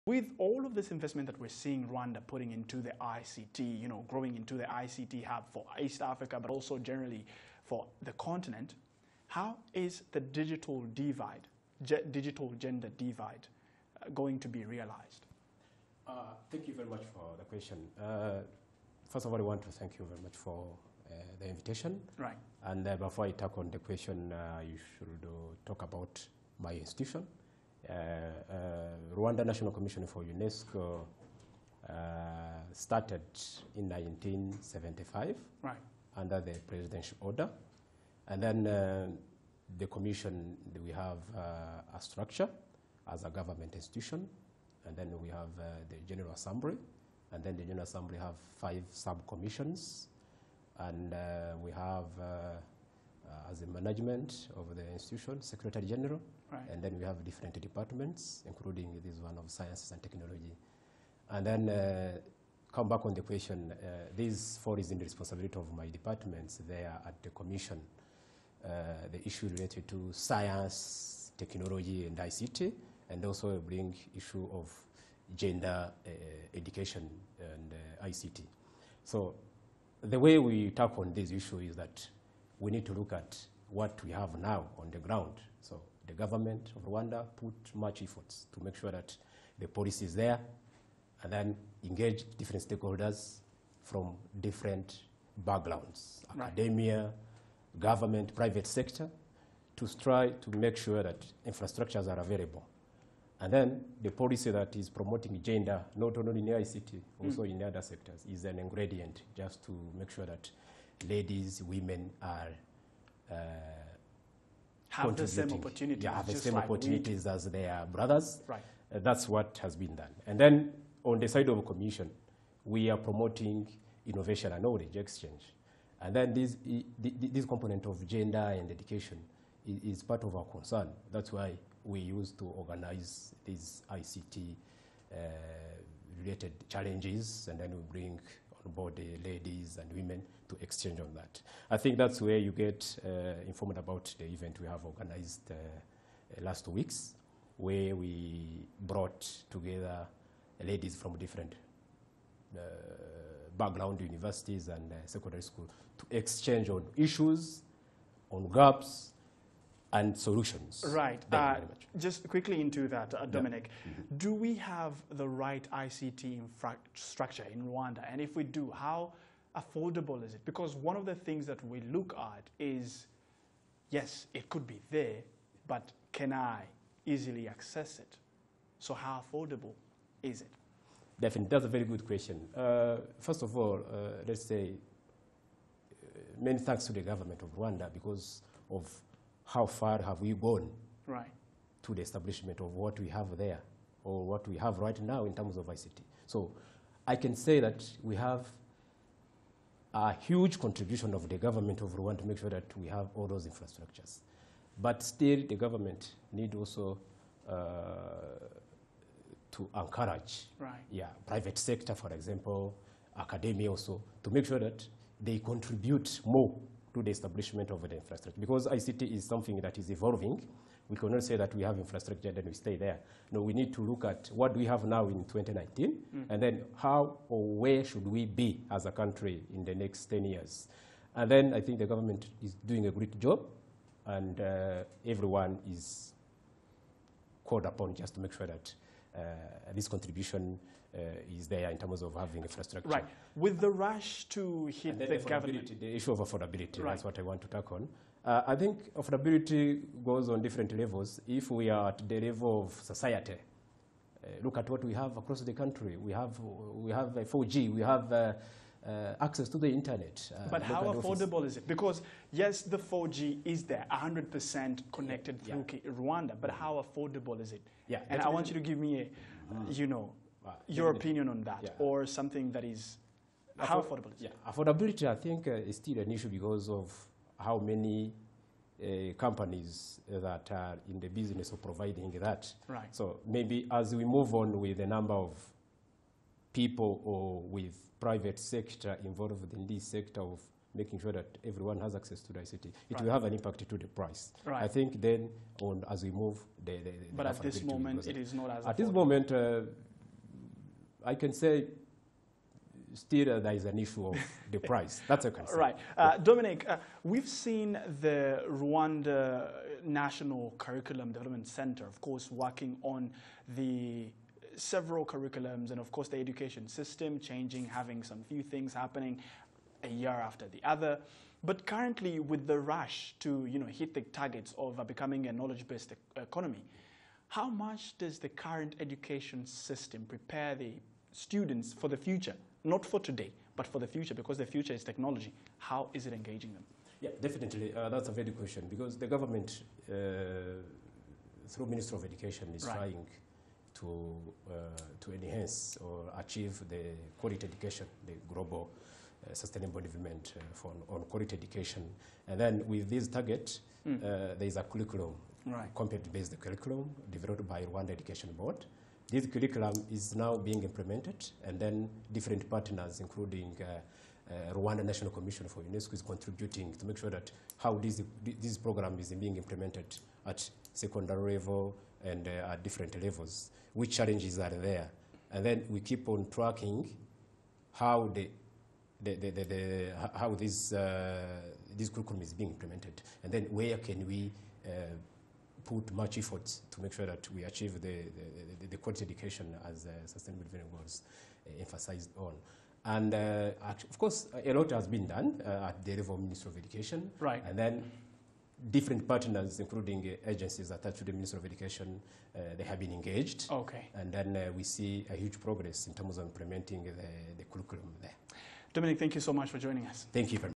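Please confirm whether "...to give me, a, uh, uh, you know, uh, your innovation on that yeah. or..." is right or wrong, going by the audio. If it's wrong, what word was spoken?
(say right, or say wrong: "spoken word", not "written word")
wrong: "opinion", not "innovation".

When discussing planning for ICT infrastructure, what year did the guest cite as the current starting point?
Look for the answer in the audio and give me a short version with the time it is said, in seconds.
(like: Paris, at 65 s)
2019, at 225 s.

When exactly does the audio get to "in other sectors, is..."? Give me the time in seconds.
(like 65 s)
107 s.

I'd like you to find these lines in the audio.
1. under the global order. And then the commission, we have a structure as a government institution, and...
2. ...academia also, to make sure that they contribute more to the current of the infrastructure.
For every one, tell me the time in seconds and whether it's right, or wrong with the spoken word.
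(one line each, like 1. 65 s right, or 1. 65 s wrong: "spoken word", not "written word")
1. 36 s wrong: "presidential", not "global"
2. 213 s wrong: "establishment", not "current".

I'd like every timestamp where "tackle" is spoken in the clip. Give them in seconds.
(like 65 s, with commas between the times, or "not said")
80 s.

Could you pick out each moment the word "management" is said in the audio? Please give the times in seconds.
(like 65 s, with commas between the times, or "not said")
53 s.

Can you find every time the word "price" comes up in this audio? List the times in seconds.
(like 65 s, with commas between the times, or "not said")
293 s, 304 s.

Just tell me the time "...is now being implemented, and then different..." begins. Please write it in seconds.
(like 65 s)
359 s.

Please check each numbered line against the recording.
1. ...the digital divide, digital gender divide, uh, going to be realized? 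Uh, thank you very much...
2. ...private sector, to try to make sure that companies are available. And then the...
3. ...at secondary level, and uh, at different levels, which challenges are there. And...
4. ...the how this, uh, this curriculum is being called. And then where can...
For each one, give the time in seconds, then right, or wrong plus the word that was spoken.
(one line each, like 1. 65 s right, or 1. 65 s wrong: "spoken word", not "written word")
1. 10 s right
2. 98 s wrong: "infrastructures", not "companies"
3. 370 s right
4. 379 s wrong: "implemented", not "called".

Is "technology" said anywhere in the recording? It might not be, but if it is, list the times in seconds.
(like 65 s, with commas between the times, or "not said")
60 s, 71 s, 334 s.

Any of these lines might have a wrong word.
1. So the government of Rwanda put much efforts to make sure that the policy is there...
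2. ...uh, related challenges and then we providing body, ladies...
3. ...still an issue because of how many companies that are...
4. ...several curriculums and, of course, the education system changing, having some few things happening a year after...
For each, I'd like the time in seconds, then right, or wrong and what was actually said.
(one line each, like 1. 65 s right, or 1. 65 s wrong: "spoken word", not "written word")
1. 85 s right
2. 135 s wrong: "bring", not "providing"
3. 275 s right
4. 314 s right.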